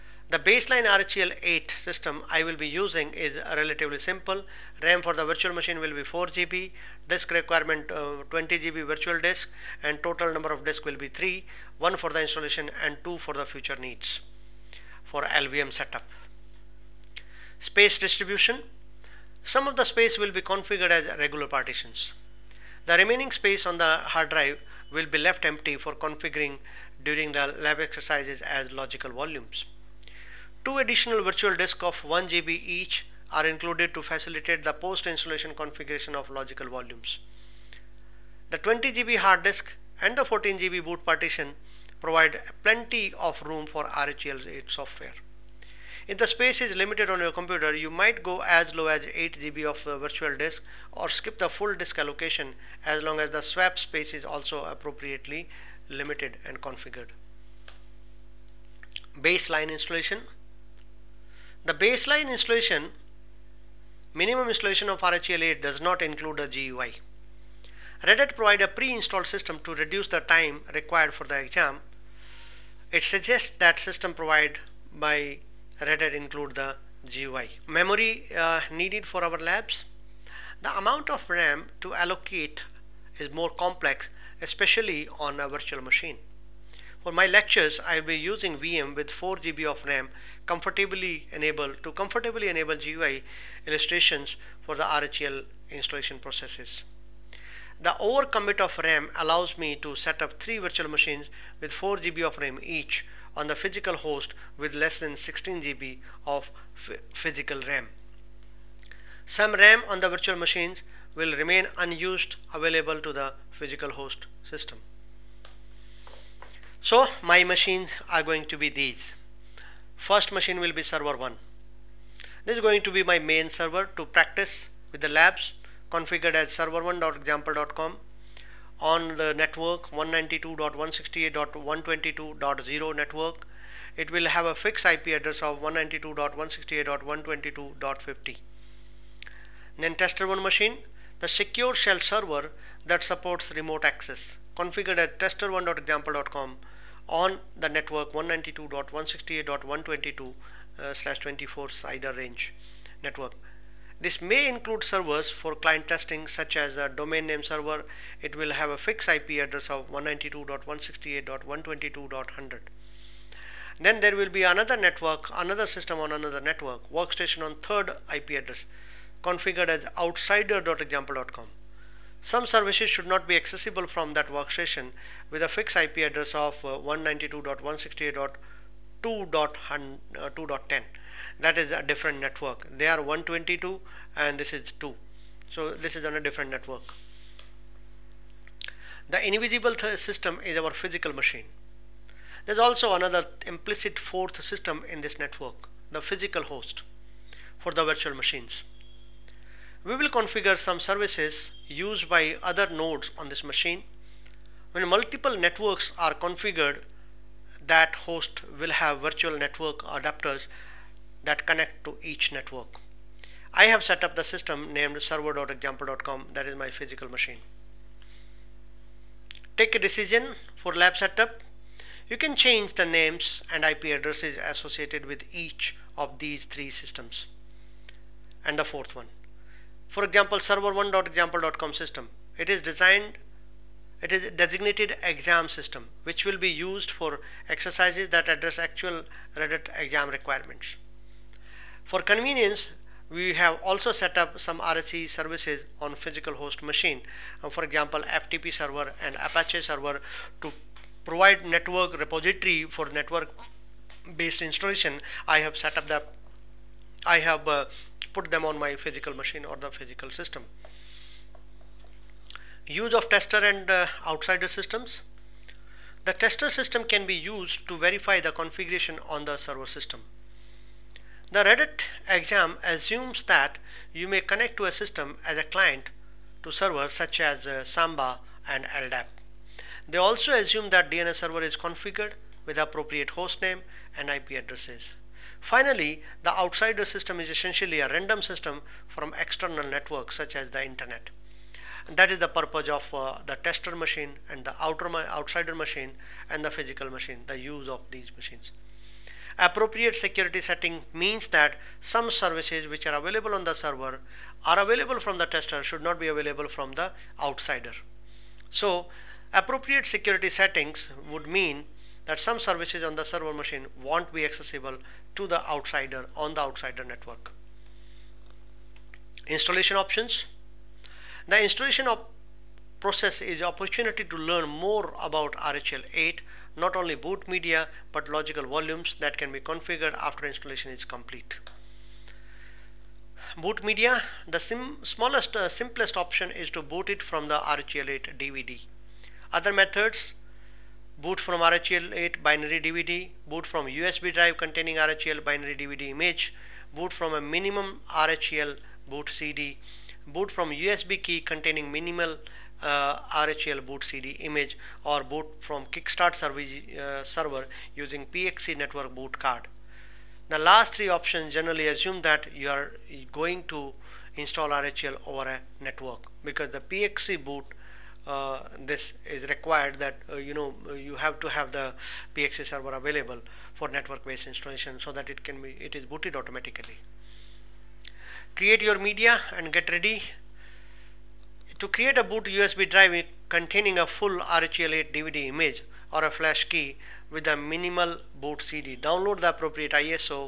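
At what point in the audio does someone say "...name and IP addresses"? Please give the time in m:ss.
4:43.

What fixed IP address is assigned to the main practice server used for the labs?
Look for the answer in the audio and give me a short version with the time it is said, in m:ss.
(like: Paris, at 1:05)
192.168.122.50, at 2:15.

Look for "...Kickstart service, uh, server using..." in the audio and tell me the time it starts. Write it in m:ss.
5:55.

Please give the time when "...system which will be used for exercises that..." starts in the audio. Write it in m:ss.
3:55.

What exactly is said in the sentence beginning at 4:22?
Use of tester and uh, outsider systems.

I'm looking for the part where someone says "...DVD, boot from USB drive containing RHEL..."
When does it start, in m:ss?
5:42.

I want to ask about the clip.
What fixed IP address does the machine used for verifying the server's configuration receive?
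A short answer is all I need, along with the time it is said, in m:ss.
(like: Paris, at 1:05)
192.168.122.100, at 2:39.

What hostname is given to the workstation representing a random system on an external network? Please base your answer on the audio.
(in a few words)
outsider.example.com.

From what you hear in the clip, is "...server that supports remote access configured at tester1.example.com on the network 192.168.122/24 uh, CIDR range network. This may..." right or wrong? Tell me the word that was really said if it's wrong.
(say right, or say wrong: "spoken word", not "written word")
right.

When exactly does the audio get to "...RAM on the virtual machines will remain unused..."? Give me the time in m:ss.
1:49.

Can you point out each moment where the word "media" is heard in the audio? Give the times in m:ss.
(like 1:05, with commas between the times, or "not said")
5:27, 5:33, 6:18.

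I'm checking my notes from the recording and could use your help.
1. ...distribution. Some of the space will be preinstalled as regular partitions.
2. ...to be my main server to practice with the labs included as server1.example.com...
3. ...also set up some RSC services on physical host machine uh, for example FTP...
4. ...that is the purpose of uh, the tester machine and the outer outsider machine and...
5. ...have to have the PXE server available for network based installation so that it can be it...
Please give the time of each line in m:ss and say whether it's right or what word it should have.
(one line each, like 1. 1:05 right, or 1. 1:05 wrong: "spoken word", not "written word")
1. 0:17 wrong: "configured", not "preinstalled"
2. 2:02 wrong: "configured", not "included"
3. 4:03 right
4. 4:51 right
5. 6:10 right.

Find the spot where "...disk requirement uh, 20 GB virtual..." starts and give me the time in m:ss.
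0:07.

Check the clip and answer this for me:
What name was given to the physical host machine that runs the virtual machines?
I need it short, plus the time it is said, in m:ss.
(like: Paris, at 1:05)
server.example.com, at 3:35.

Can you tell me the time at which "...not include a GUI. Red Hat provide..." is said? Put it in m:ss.
1:05.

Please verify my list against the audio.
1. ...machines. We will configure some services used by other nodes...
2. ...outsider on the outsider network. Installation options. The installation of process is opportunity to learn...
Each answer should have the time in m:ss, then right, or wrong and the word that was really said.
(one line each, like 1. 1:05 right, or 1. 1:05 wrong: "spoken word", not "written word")
1. 3:18 right
2. 5:15 right.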